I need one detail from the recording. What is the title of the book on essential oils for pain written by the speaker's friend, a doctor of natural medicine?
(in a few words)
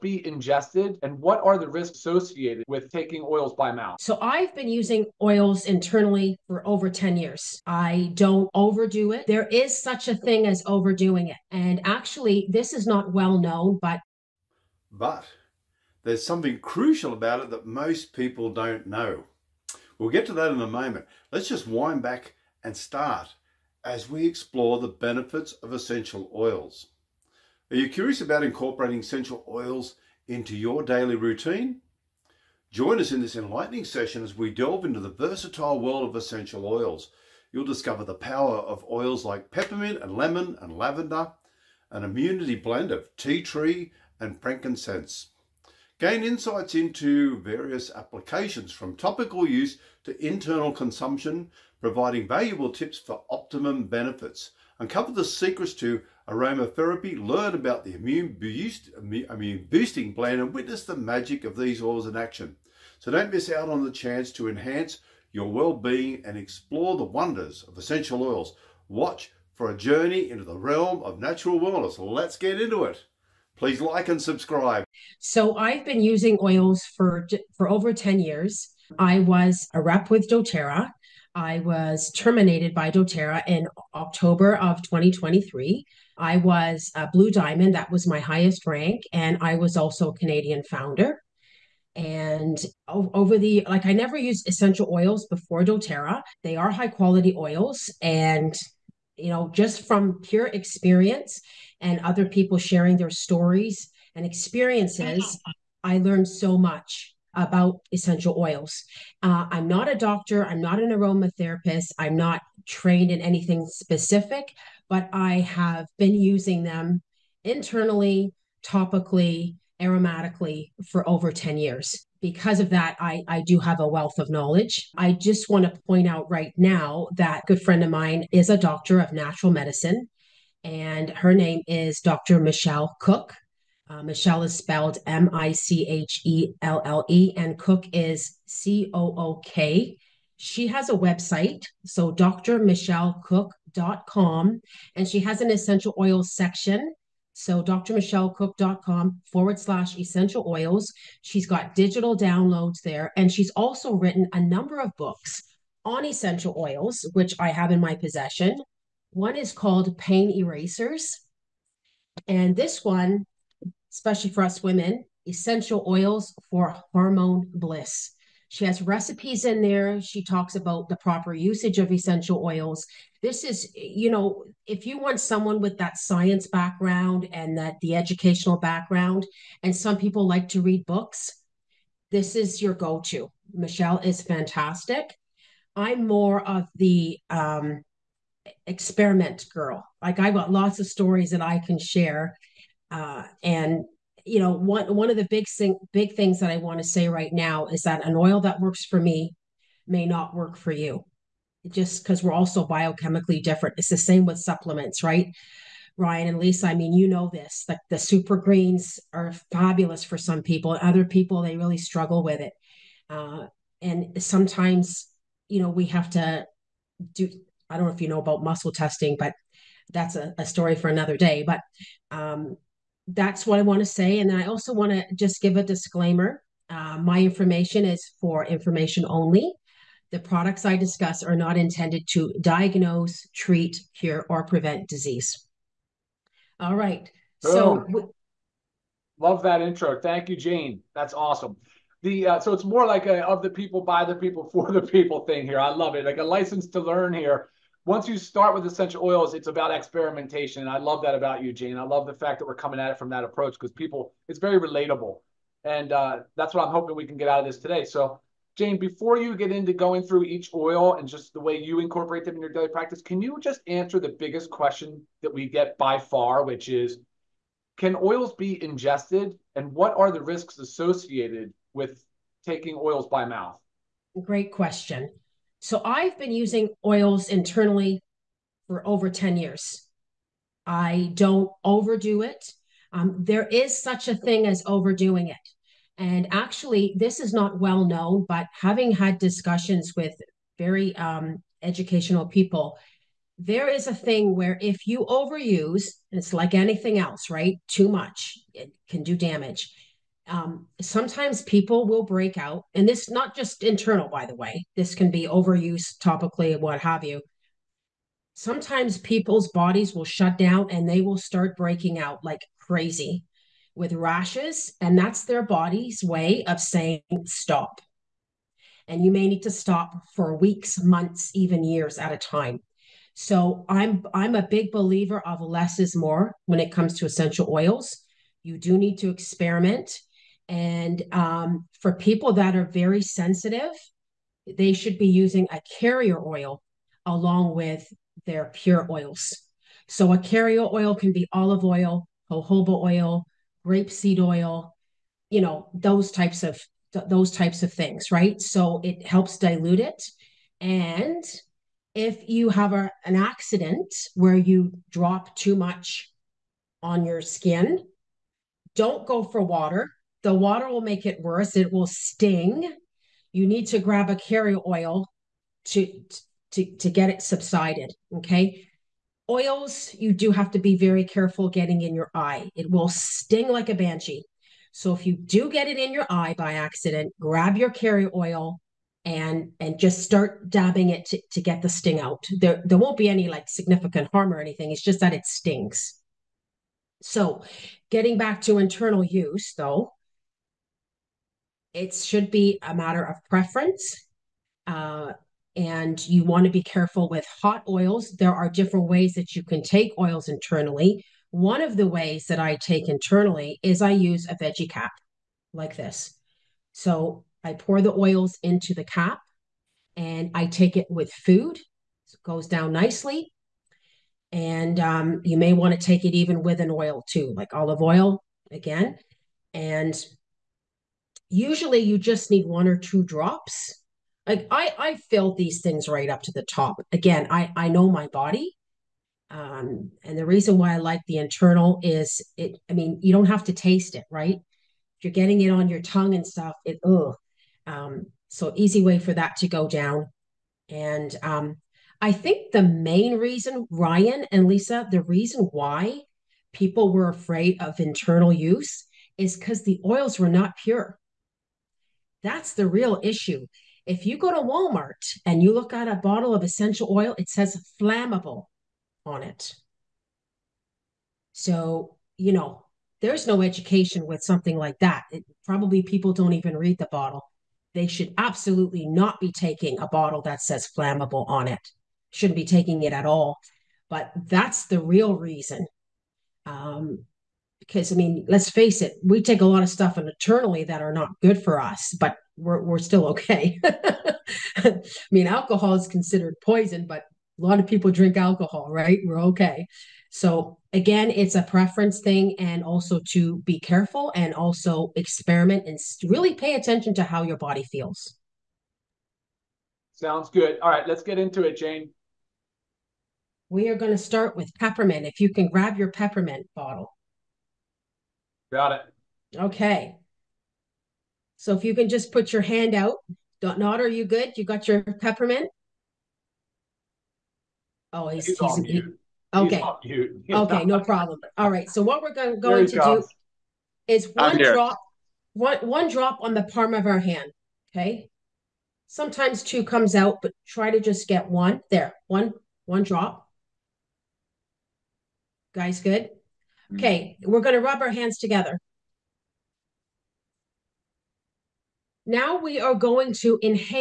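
Pain Erasers.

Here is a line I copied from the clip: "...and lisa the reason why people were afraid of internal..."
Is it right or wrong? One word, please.
right.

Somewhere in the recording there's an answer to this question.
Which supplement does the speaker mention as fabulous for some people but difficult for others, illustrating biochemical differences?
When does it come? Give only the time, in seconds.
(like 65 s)
207 s.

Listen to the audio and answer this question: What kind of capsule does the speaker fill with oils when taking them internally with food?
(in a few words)
veggie cap.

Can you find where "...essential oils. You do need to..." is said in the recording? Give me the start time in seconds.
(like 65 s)
327 s.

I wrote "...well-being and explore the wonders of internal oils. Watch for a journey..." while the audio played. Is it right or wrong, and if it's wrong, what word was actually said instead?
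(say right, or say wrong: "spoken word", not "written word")
wrong: "essential", not "internal".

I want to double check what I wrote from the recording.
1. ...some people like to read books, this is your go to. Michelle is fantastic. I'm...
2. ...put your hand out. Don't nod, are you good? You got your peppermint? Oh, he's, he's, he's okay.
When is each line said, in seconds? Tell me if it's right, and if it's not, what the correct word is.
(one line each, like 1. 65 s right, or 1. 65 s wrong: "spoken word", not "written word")
1. 179 s right
2. 512 s right.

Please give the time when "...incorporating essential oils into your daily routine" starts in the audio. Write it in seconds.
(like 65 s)
28 s.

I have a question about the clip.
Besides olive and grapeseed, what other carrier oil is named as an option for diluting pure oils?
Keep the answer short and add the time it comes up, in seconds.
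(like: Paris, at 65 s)
jojoba oil, at 342 s.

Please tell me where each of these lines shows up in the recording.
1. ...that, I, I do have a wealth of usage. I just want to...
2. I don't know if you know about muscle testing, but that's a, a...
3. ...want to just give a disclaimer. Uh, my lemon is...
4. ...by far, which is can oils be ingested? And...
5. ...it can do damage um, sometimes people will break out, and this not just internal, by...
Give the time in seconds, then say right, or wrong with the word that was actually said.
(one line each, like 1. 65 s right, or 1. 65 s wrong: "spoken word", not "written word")
1. 122 s wrong: "knowledge", not "usage"
2. 217 s right
3. 224 s wrong: "information", not "lemon"
4. 265 s right
5. 298 s right.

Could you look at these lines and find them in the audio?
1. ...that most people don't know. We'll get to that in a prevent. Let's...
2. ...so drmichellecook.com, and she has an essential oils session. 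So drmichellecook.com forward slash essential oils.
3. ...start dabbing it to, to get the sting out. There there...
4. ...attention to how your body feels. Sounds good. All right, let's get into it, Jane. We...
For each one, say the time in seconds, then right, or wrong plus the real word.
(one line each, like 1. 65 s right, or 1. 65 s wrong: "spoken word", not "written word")
1. 17 s wrong: "moment", not "prevent"
2. 141 s wrong: "section", not "session"
3. 380 s right
4. 496 s right.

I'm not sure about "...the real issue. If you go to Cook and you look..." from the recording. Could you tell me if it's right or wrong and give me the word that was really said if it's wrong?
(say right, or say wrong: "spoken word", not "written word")
wrong: "Walmart", not "Cook".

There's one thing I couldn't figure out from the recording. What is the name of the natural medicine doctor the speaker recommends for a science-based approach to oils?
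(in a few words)
Dr. Michelle Cook.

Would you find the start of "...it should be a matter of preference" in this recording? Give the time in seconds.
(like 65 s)
391 s.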